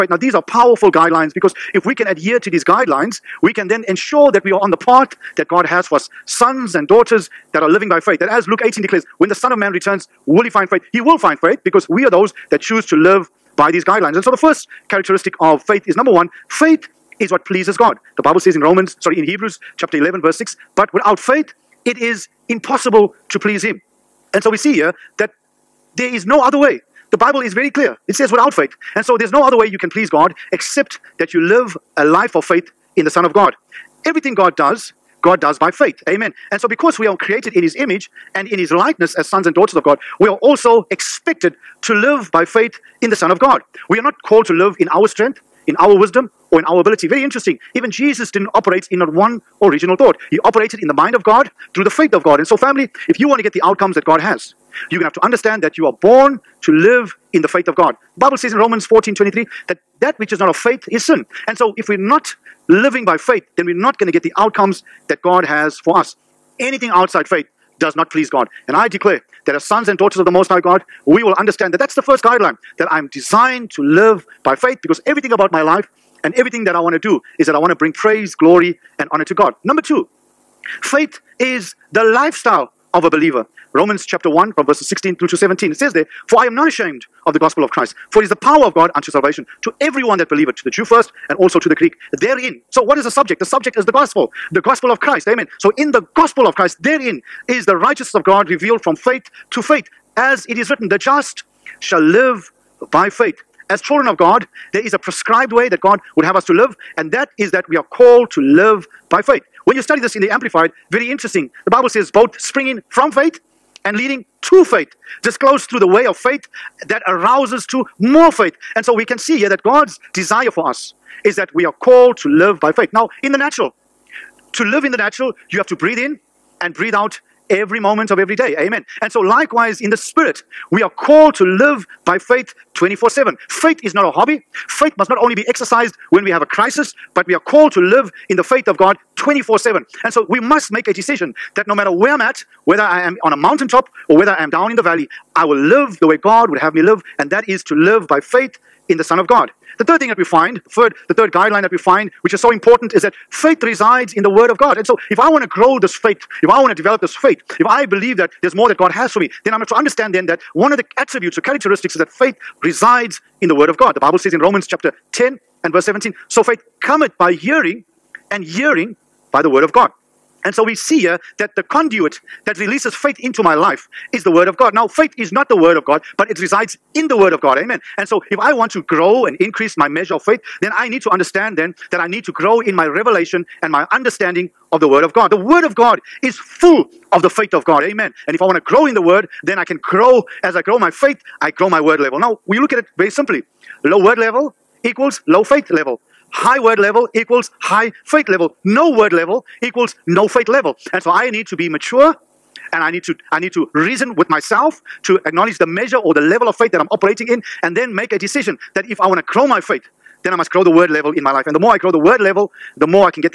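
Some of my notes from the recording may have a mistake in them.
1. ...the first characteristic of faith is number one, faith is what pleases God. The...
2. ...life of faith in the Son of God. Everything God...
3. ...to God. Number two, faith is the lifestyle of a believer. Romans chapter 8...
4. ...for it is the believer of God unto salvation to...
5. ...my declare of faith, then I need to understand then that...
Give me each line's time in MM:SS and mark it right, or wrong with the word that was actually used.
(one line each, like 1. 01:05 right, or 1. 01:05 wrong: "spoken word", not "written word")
1. 00:14 right
2. 00:32 right
3. 01:19 wrong: "1", not "8"
4. 01:28 wrong: "power", not "believer"
5. 02:59 wrong: "measure", not "declare".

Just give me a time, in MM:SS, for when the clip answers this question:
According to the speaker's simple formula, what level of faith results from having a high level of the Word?
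03:16.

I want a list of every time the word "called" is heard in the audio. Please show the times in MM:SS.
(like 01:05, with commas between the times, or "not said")
00:44, 01:47, 02:01, 02:10, 02:17.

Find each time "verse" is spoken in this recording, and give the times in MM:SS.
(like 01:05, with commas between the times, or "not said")
00:20, 01:24, 02:45.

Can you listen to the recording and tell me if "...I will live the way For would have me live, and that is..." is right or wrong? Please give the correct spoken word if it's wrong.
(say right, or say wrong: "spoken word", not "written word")
wrong: "God", not "For".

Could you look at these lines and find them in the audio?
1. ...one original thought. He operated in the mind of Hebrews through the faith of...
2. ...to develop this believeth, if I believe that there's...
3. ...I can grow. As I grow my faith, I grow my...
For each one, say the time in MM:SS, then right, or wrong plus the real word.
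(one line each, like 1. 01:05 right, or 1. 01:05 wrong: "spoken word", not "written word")
1. 00:49 wrong: "God", not "Hebrews"
2. 02:36 wrong: "faith", not "believeth"
3. 03:09 right.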